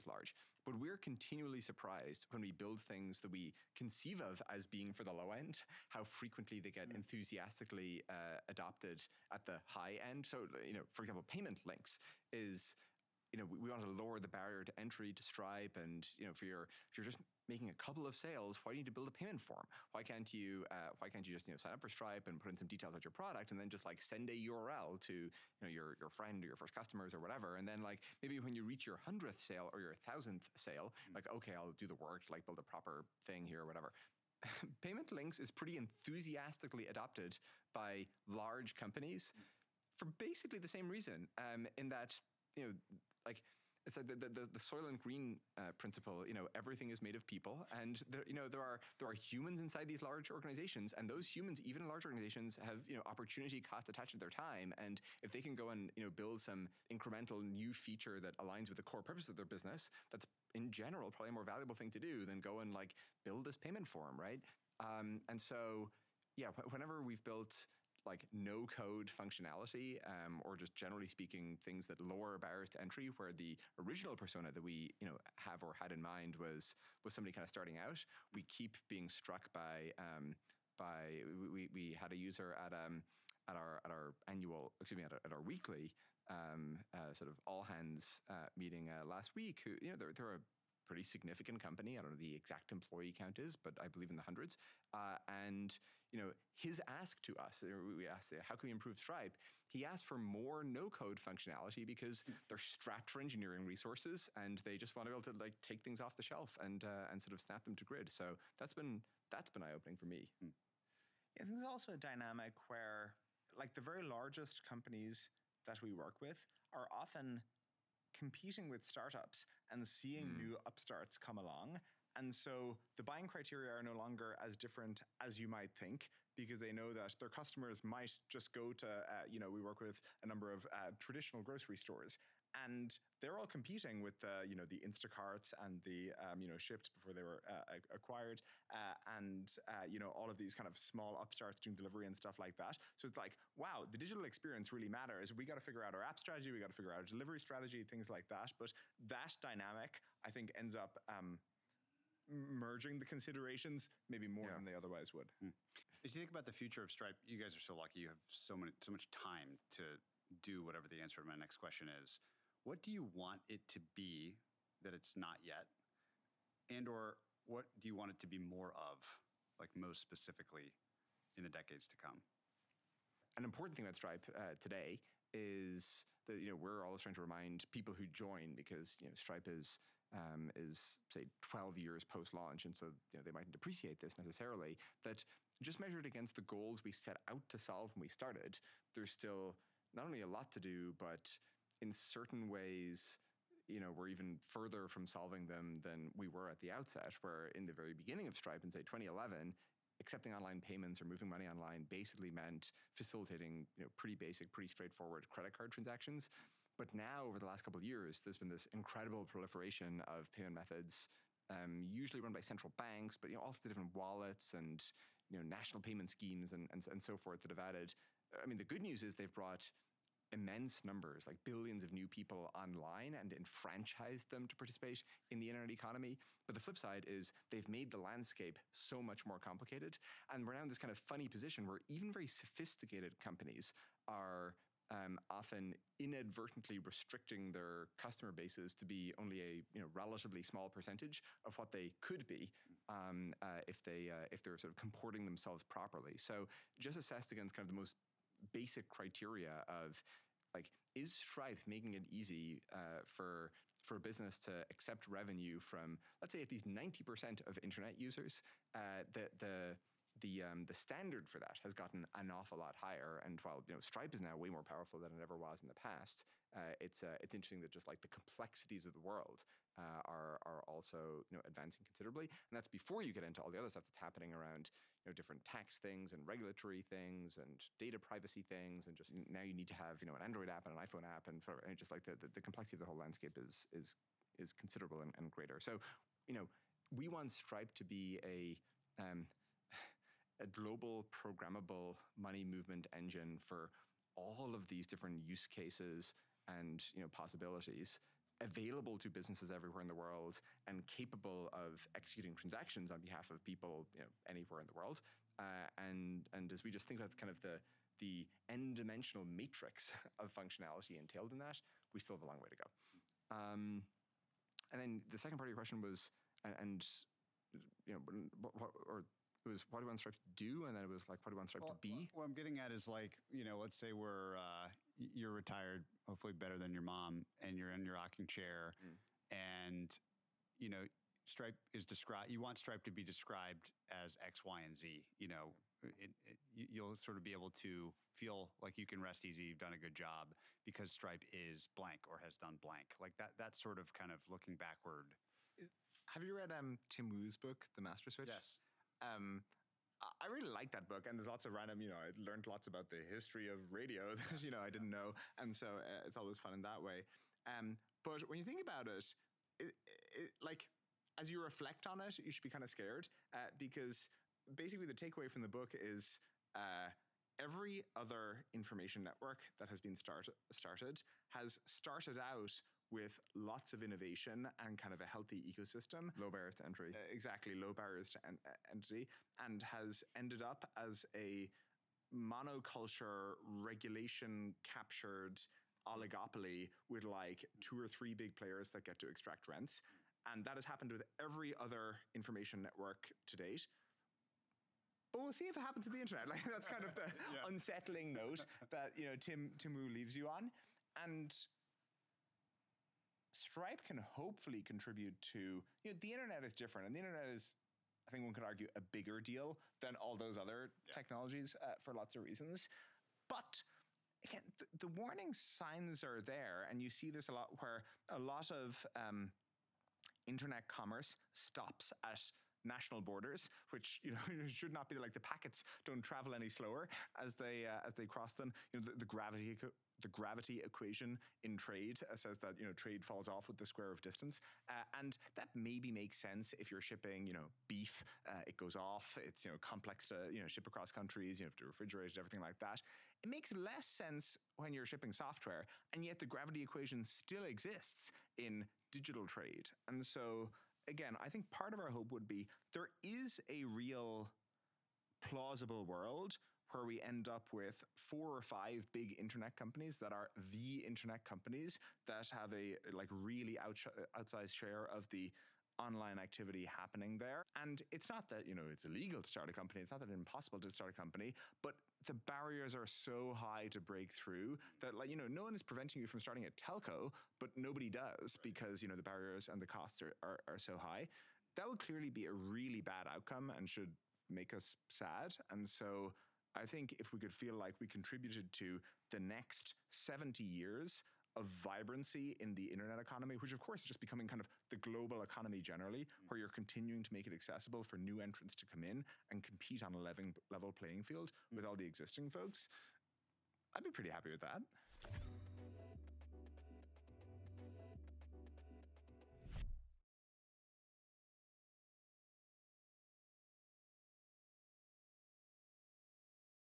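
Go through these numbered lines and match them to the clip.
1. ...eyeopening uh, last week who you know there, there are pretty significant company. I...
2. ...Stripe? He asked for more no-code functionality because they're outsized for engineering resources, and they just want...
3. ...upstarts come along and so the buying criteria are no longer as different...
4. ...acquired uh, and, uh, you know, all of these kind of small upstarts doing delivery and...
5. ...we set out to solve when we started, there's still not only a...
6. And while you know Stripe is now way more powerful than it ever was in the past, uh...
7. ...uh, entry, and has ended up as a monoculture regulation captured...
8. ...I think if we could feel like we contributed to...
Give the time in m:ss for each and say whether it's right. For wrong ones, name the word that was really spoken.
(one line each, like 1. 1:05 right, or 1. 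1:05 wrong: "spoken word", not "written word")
1. 1:28 wrong: "meeting", not "eyeopening"
2. 1:38 wrong: "strapped", not "outsized"
3. 2:00 right
4. 2:17 right
5. 3:06 right
6. 4:23 right
7. 6:18 right
8. 8:06 right.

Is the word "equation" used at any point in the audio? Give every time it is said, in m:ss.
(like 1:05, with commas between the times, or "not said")
7:10, 7:26.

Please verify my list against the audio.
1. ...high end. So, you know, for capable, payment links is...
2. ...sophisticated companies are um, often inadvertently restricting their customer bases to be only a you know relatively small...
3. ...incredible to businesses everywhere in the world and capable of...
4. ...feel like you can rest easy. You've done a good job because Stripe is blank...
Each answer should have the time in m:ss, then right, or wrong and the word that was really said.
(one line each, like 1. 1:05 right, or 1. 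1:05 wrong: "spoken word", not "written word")
1. 0:09 wrong: "example", not "capable"
2. 3:52 right
3. 4:58 wrong: "available", not "incredible"
4. 5:38 right.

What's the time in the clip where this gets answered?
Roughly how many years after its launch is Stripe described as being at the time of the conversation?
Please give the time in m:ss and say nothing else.
3:01.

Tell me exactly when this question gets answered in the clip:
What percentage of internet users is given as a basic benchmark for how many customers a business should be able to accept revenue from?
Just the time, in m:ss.
4:16.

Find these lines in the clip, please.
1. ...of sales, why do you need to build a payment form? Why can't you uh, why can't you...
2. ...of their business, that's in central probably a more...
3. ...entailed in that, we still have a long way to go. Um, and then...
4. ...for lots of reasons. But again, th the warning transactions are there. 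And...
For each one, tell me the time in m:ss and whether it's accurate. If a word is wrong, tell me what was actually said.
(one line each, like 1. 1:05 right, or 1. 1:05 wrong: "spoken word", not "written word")
1. 0:18 right
2. 0:59 wrong: "general", not "central"
3. 5:10 right
4. 6:51 wrong: "signs", not "transactions".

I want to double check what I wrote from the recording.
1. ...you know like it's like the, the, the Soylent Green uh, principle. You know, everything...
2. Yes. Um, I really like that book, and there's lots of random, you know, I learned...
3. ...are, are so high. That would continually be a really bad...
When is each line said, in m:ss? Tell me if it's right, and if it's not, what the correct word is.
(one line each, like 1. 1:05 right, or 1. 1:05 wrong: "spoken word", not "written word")
1. 0:42 right
2. 5:48 right
3. 8:00 wrong: "clearly", not "continually".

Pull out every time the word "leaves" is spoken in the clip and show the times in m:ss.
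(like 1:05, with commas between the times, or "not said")
6:39.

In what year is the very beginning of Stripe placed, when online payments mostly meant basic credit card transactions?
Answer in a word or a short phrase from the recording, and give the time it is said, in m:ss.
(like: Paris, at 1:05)
2011, at 3:18.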